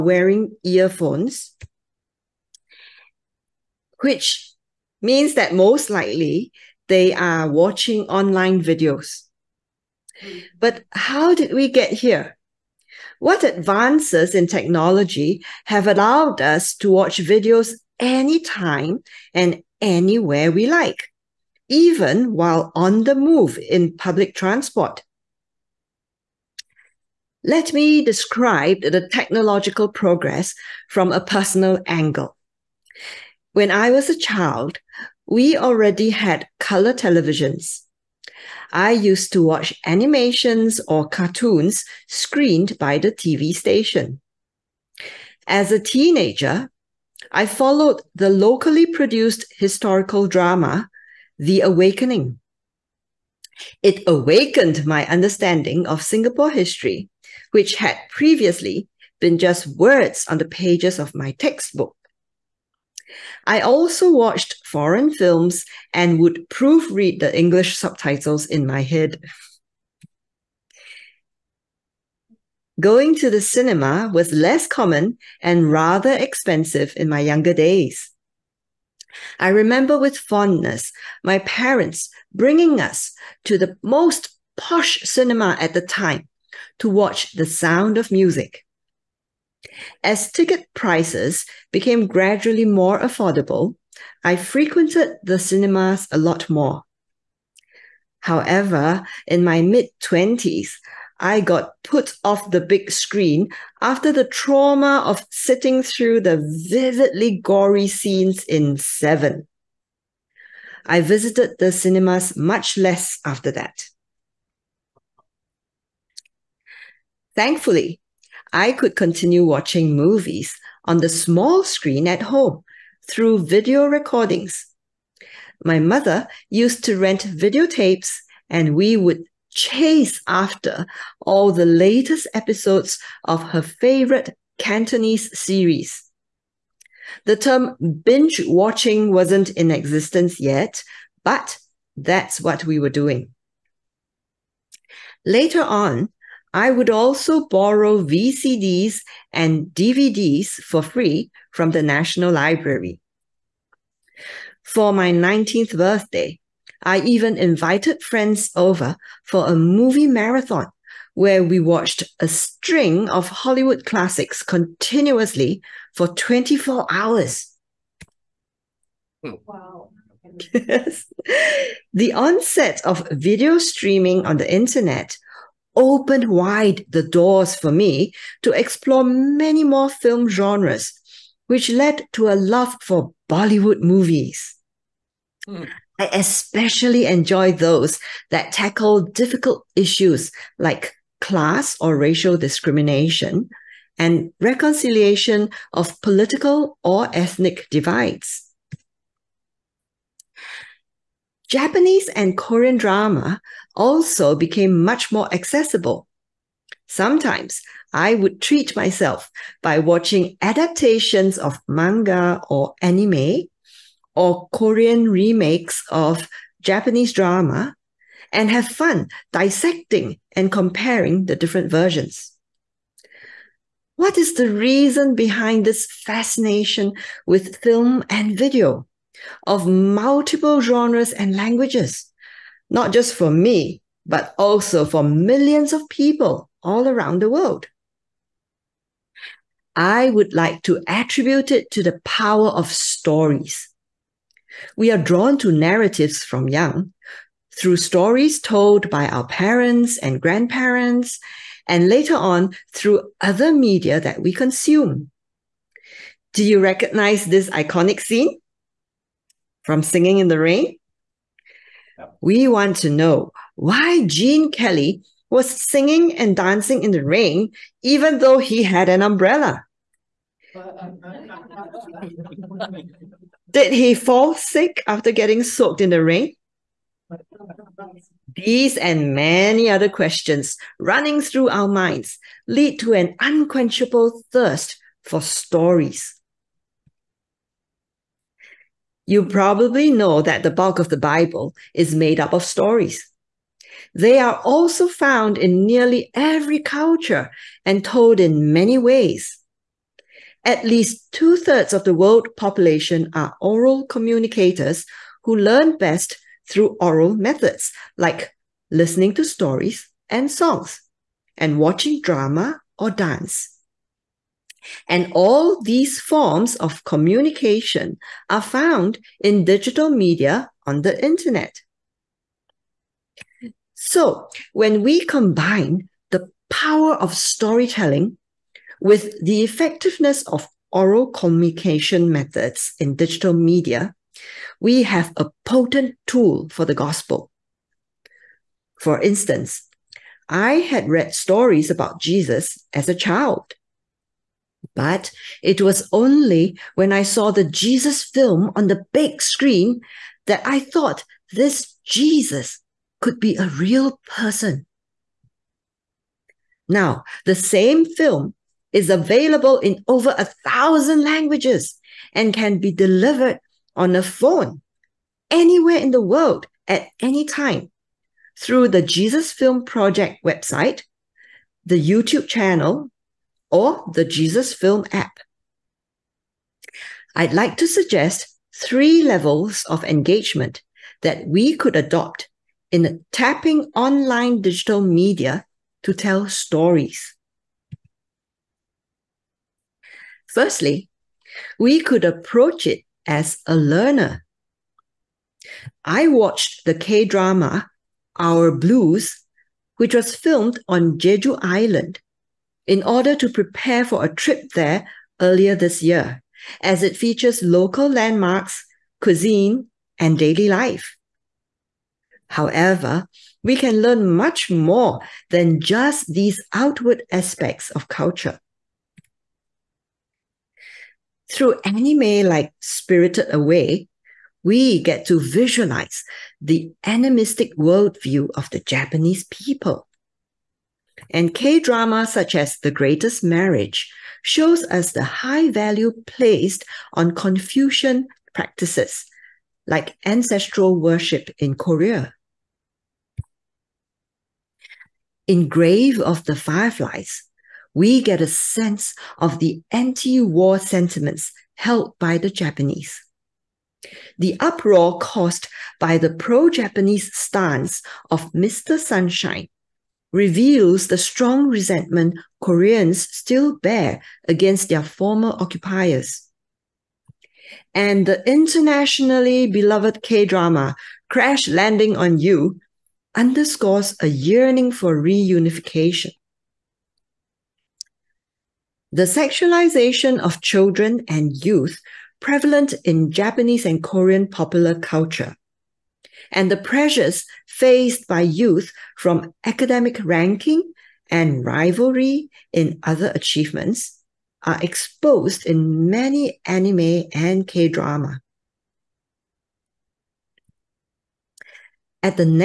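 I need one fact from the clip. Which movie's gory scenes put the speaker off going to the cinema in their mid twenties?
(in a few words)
Seven.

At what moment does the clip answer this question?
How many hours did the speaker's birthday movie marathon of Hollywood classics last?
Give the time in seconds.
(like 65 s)
166 s.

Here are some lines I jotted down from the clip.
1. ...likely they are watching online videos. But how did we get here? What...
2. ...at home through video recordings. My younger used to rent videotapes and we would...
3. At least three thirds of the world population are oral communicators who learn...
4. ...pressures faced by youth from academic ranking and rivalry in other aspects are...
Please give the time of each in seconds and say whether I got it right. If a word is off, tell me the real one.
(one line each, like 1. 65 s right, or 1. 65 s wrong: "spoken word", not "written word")
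1. 5 s right
2. 122 s wrong: "mother", not "younger"
3. 300 s wrong: "two", not "three"
4. 486 s wrong: "achievements", not "aspects".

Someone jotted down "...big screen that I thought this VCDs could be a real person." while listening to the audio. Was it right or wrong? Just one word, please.
wrong.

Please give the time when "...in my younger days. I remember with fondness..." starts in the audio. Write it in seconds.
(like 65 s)
76 s.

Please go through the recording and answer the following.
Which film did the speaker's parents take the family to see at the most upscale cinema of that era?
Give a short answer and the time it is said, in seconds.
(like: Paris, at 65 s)
The Sound of Music, at 87 s.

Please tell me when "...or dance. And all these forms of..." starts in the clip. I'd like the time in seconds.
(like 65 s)
312 s.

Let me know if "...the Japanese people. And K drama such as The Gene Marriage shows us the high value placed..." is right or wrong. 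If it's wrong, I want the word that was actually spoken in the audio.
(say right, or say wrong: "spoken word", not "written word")
wrong: "Greatest", not "Gene".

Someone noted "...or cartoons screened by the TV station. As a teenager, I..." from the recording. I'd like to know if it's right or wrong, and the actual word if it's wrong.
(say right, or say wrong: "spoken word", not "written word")
right.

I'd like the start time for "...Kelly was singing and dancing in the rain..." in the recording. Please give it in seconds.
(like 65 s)
264 s.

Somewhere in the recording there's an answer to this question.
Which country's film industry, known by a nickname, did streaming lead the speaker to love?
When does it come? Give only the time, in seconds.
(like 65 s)
183 s.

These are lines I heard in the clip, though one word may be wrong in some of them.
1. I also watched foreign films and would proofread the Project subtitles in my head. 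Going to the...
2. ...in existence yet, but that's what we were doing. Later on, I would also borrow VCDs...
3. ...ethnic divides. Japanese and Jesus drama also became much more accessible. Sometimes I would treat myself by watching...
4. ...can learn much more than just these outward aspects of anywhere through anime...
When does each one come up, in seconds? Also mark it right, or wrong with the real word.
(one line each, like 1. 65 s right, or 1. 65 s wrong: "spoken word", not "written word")
1. 63 s wrong: "English", not "Project"
2. 139 s right
3. 197 s wrong: "Korean", not "Jesus"
4. 413 s wrong: "culture", not "anywhere".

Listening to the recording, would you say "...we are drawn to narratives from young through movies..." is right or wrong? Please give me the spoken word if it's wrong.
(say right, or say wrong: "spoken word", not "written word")
wrong: "stories", not "movies".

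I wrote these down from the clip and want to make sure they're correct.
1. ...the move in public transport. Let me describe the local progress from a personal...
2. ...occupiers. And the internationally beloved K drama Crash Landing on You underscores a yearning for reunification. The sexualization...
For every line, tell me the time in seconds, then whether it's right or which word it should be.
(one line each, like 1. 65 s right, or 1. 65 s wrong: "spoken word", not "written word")
1. 23 s wrong: "technological", not "local"
2. 465 s right.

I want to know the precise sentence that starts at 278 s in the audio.
These and many other questions running through our minds lead to an unquenchable thirst for stories.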